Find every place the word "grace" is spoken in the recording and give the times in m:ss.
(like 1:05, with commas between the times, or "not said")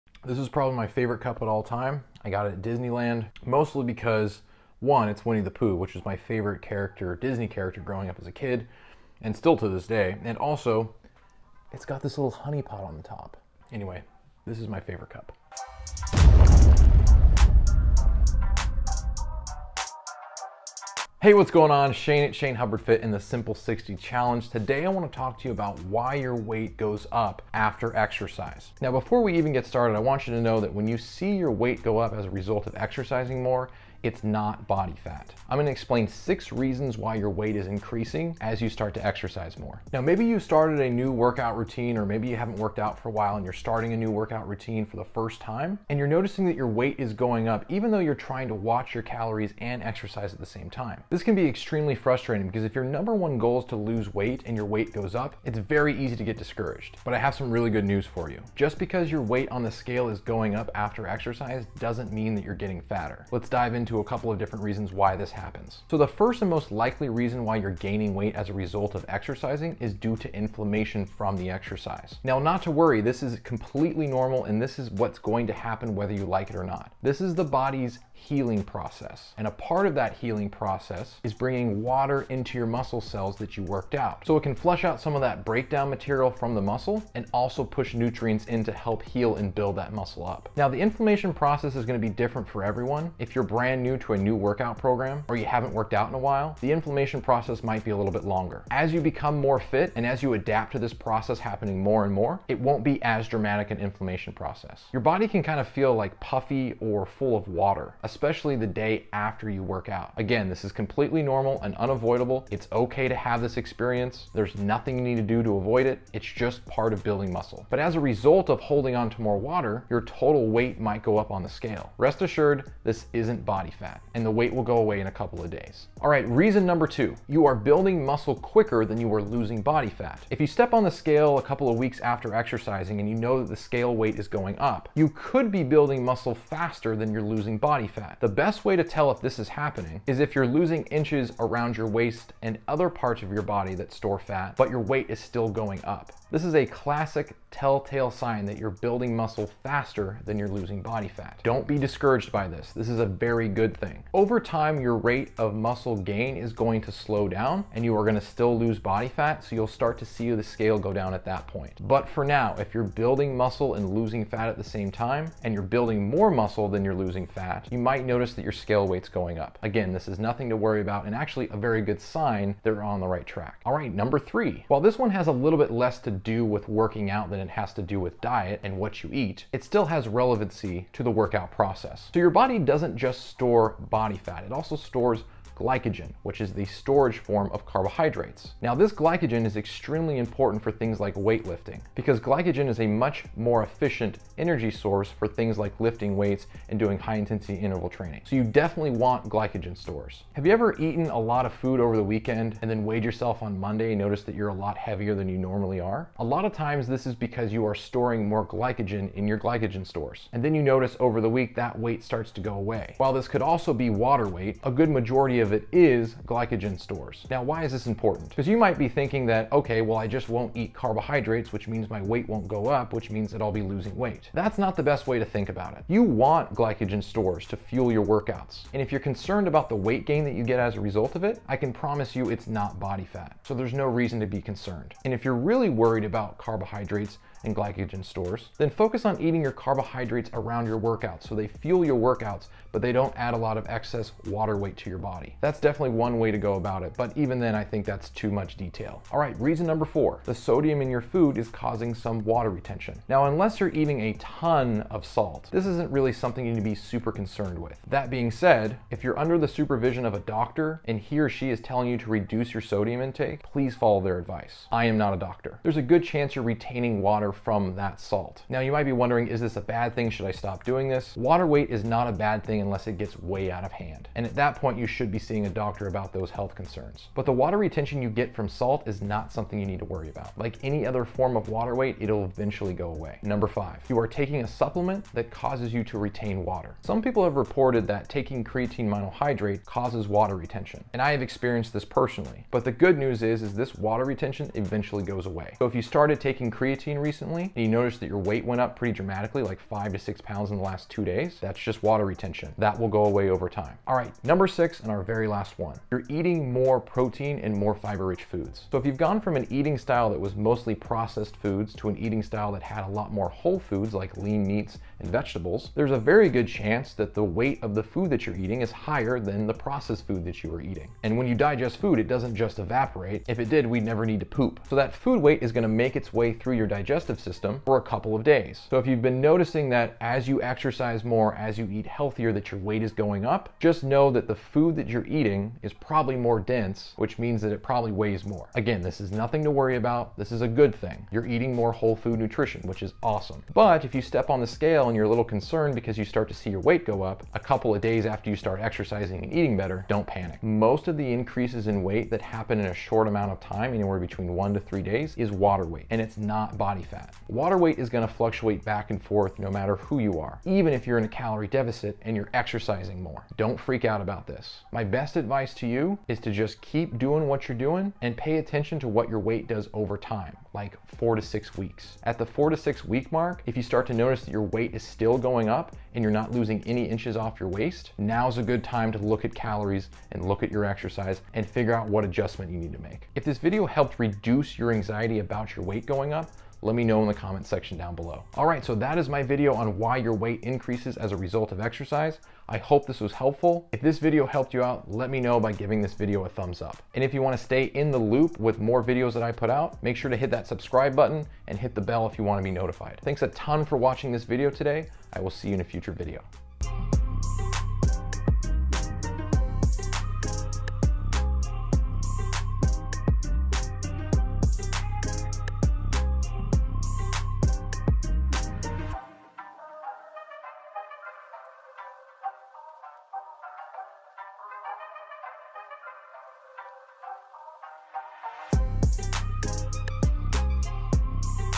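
not said.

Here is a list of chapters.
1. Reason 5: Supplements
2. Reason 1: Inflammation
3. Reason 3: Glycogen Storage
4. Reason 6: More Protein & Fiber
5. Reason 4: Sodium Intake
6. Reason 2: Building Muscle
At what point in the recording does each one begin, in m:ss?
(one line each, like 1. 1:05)
1. 4:43
2. 1:05
3. 2:53
4. 5:03
5. 4:09
6. 2:06.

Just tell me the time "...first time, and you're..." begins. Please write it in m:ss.
0:45.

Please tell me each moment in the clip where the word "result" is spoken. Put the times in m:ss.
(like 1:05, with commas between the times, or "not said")
0:32, 1:08, 1:57, 3:50, 6:31.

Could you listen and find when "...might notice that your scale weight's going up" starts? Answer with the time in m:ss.
2:47.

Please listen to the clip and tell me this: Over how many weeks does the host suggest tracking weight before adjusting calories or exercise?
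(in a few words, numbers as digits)
4 to 6 weeks.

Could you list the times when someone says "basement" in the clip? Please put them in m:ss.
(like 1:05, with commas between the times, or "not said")
not said.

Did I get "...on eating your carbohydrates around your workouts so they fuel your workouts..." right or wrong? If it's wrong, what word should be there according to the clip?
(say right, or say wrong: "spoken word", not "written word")
right.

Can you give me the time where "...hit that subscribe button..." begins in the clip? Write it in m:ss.
6:40.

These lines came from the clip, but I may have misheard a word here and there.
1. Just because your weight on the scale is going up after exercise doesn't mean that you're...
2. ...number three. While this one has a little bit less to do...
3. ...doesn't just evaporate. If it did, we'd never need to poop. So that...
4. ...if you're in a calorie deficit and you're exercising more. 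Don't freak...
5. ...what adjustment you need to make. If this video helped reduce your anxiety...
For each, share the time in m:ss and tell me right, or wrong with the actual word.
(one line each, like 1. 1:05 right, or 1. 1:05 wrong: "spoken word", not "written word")
1. 0:58 right
2. 2:53 right
3. 5:22 right
4. 6:00 right
5. 6:21 right.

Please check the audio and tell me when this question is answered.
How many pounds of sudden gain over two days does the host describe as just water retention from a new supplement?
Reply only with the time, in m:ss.
4:59.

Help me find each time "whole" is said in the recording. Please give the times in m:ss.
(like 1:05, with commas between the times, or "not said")
5:13, 5:41.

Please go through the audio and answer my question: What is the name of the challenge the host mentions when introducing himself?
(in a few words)
Simple 60 Challenge.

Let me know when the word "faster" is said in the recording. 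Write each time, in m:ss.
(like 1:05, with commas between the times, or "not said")
2:16, 2:29.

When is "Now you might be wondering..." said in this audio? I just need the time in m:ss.
4:28.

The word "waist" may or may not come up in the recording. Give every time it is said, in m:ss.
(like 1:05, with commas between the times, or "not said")
2:21, 6:17.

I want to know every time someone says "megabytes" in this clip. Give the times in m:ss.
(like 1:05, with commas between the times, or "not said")
not said.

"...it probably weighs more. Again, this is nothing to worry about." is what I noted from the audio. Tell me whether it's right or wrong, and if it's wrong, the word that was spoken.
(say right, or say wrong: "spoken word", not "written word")
right.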